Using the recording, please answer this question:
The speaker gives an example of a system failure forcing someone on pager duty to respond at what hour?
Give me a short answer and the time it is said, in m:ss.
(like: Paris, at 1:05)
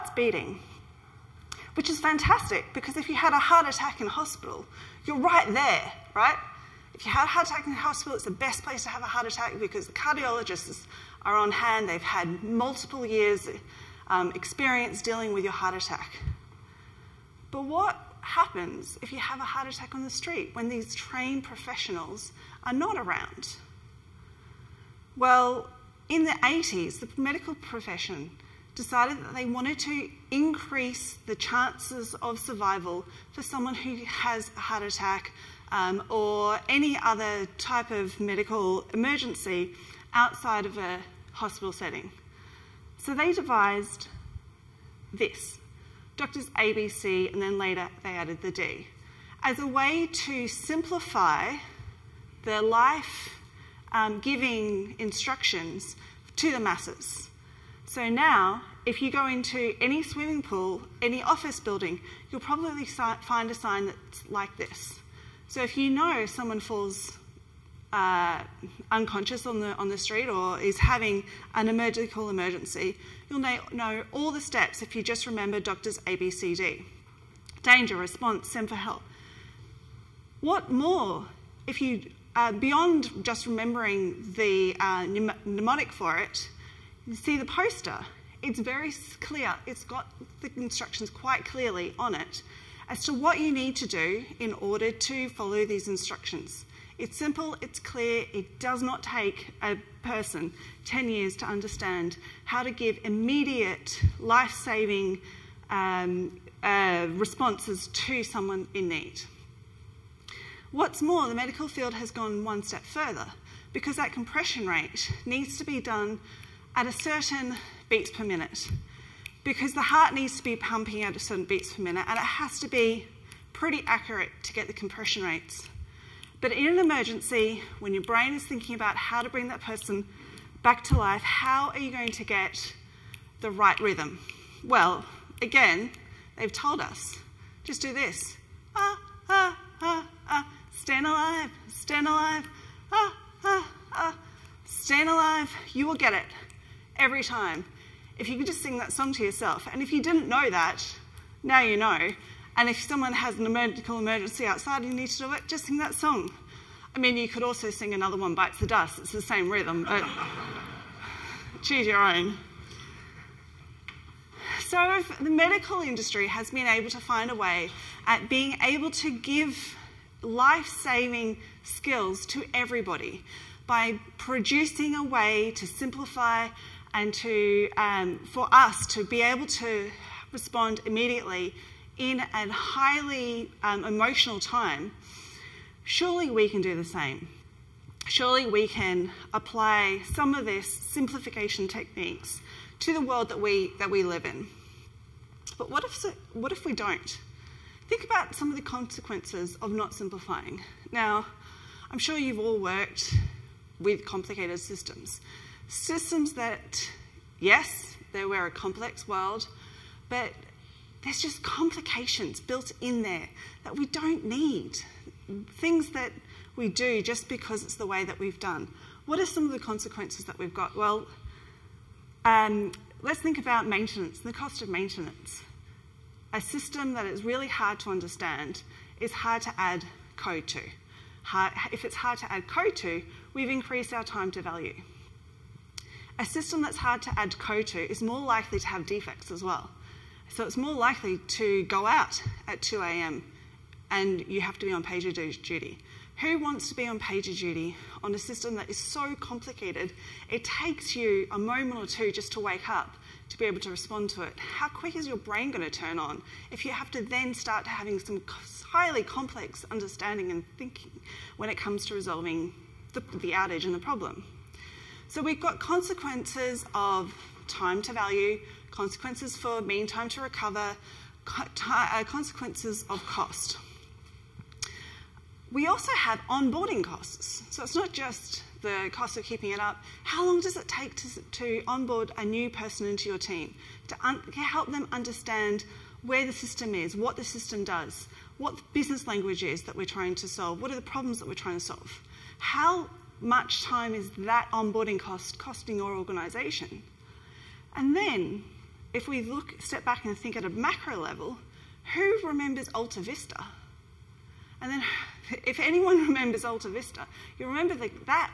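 2 a.m., at 4:02.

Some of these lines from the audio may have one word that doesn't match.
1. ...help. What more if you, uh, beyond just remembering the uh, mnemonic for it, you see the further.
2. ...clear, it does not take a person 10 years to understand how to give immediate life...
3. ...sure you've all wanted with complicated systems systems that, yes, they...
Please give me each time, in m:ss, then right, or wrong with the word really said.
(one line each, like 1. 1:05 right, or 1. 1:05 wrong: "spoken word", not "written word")
1. 1:18 wrong: "poster", not "further"
2. 1:37 right
3. 3:21 wrong: "worked", not "wanted".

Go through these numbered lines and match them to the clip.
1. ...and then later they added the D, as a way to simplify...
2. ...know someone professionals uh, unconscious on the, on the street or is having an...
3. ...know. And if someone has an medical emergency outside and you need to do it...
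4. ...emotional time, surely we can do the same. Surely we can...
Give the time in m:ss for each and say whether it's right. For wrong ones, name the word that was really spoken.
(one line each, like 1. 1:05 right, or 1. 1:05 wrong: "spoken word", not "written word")
1. 0:47 right
2. 1:05 wrong: "falls", not "professionals"
3. 2:31 right
4. 3:03 right.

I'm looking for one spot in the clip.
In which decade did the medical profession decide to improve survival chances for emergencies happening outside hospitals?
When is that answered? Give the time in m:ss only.
0:26.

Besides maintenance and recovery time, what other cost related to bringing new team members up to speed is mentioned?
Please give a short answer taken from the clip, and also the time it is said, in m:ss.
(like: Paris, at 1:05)
onboarding costs, at 4:36.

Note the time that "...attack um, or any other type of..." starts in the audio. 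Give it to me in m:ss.
0:34.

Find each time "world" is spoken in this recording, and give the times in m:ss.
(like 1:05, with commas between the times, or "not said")
3:13, 3:29.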